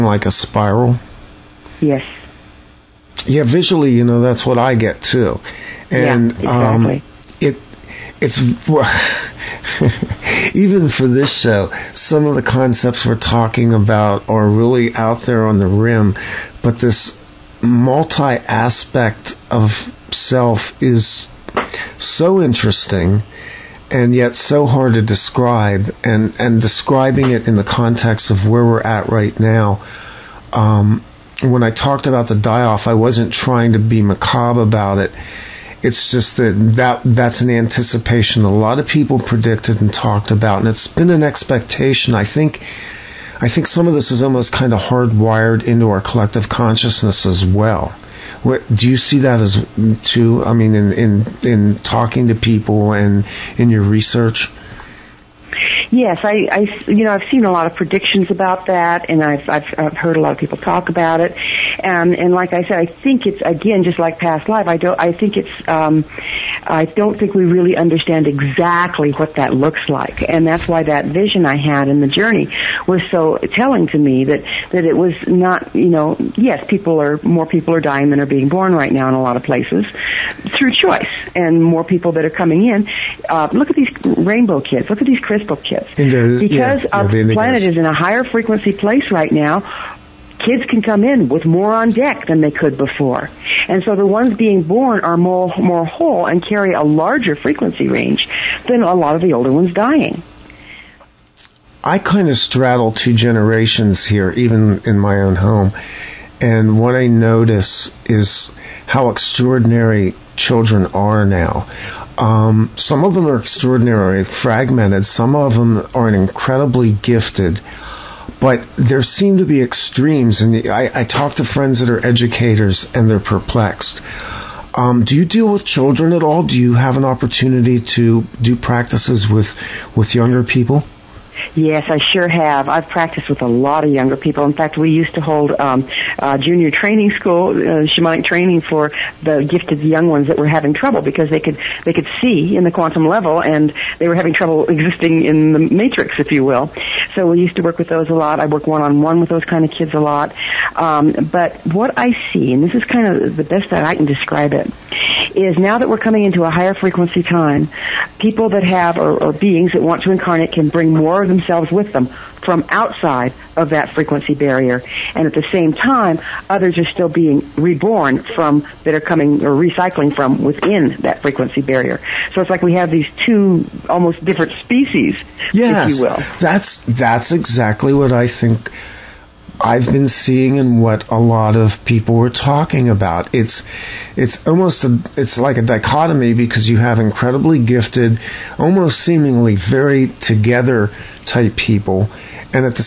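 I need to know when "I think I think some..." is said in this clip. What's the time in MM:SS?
00:42.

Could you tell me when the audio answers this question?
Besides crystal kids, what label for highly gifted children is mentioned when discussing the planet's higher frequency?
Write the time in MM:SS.
01:24.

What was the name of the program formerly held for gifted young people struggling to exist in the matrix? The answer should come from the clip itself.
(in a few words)
Junior training school.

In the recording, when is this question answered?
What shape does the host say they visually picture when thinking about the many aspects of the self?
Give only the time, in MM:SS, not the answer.
00:00.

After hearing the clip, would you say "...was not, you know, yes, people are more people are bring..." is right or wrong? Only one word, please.
wrong.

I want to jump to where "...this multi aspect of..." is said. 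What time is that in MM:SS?
00:16.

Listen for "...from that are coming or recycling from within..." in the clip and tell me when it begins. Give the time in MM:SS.
02:48.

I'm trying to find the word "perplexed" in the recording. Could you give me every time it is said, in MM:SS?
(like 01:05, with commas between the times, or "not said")
02:03.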